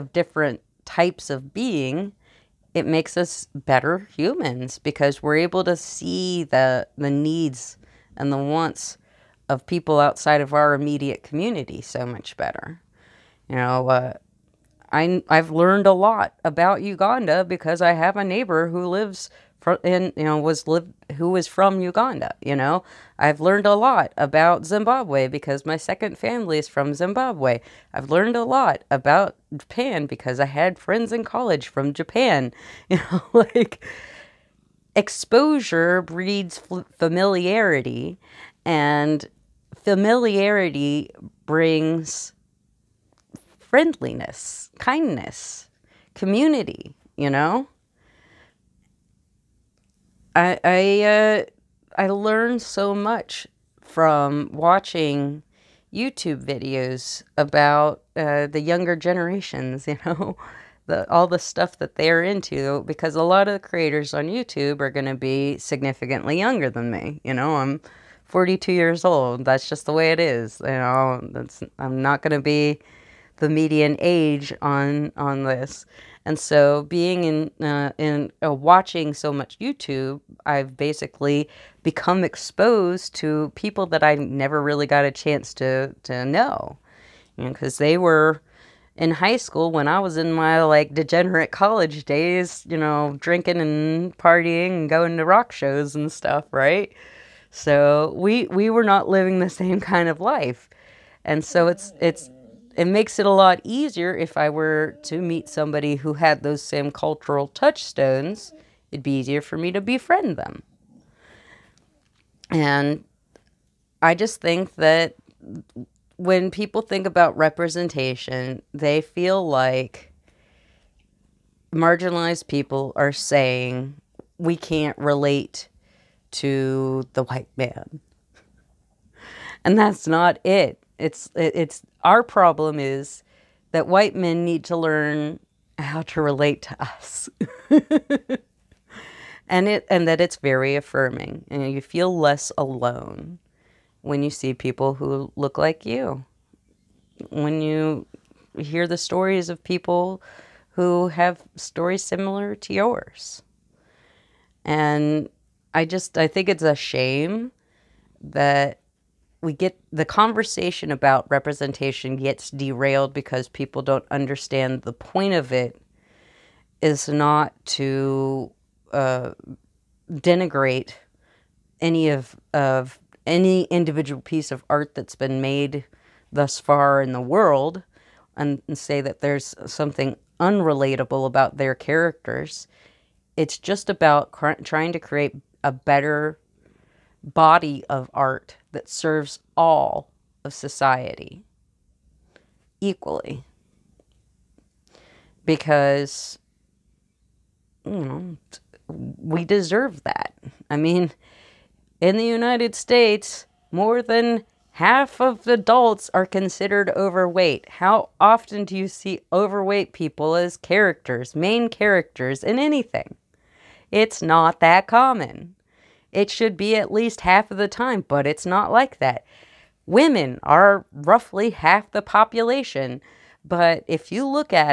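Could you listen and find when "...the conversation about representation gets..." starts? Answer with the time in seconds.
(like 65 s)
159 s.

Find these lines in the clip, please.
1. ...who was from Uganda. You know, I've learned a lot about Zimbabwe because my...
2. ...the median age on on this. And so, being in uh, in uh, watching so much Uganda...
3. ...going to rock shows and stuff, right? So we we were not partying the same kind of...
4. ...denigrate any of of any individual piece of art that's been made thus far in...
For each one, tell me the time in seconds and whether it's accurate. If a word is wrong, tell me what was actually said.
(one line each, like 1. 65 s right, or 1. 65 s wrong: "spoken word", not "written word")
1. 21 s right
2. 73 s wrong: "YouTube", not "Uganda"
3. 94 s wrong: "living", not "partying"
4. 170 s right.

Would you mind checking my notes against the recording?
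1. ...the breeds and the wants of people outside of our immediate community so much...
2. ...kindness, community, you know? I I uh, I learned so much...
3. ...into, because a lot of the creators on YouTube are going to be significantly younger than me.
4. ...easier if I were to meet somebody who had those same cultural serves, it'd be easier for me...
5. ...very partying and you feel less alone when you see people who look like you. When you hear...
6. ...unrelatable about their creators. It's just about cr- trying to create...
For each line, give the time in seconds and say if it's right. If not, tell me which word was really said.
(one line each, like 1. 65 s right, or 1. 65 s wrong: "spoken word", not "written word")
1. 6 s wrong: "needs", not "breeds"
2. 44 s right
3. 62 s right
4. 103 s wrong: "touchstones", not "serves"
5. 140 s wrong: "affirming", not "partying"
6. 180 s wrong: "characters", not "creators".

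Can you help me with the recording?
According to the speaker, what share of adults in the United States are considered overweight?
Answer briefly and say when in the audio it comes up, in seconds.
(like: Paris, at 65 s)
more than half, at 203 s.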